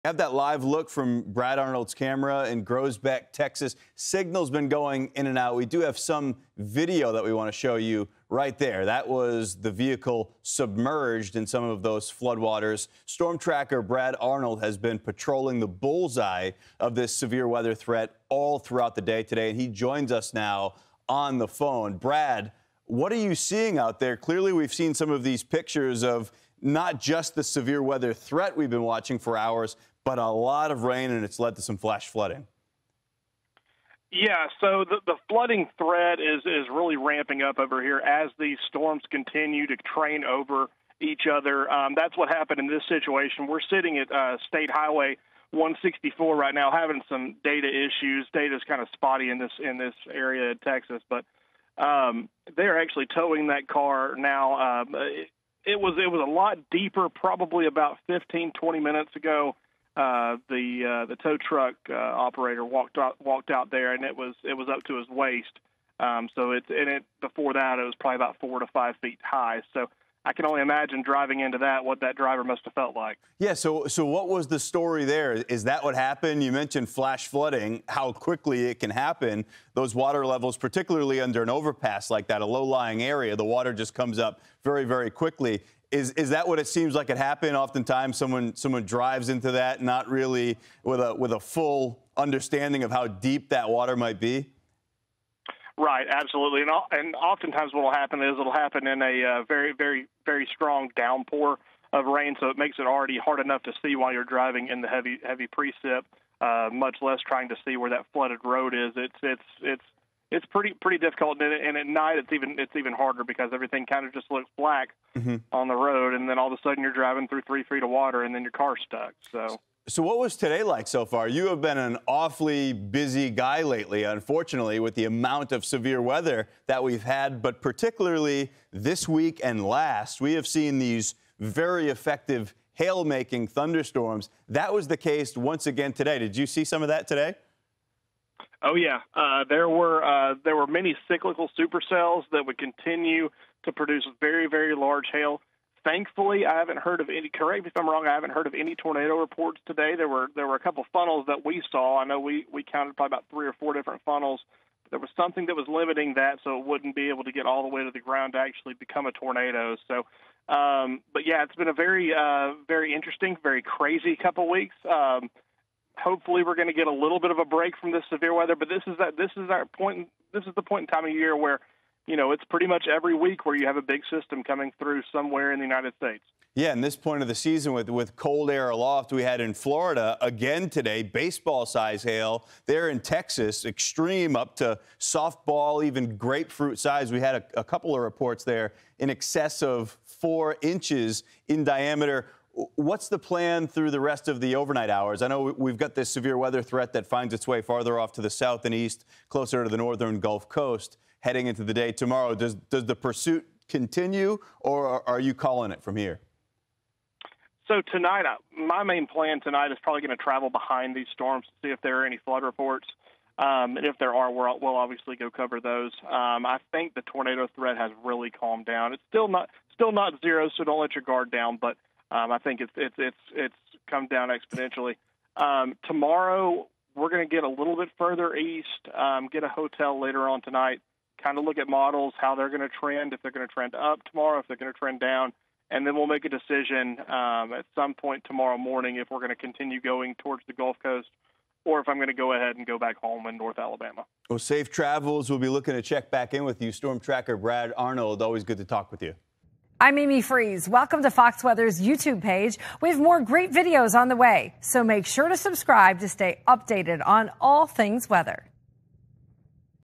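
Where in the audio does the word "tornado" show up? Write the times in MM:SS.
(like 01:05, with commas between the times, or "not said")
02:28, 02:39, 03:37.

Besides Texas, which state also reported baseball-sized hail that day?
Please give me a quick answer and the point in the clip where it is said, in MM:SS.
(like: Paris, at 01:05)
Florida, at 02:59.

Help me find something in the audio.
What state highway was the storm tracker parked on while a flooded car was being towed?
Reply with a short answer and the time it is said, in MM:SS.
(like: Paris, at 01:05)
State Highway 164, at 00:44.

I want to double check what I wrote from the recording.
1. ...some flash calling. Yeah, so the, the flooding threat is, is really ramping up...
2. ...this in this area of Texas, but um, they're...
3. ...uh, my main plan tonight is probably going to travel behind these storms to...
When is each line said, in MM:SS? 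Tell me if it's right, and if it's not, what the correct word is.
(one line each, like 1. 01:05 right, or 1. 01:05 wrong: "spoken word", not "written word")
1. 00:31 wrong: "flooding", not "calling"
2. 00:49 right
3. 03:28 right.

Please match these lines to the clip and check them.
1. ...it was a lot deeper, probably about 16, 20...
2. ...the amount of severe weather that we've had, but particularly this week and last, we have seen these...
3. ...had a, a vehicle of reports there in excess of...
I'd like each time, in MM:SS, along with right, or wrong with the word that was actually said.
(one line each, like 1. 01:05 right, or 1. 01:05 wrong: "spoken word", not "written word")
1. 00:55 wrong: "15", not "16"
2. 02:04 right
3. 03:07 wrong: "couple", not "vehicle".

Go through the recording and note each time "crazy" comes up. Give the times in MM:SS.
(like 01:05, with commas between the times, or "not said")
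02:43.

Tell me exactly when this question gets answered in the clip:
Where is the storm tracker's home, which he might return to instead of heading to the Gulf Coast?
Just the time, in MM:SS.
04:03.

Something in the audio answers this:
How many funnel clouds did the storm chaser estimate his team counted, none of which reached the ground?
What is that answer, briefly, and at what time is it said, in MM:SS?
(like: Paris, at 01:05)
3 or 4, at 02:33.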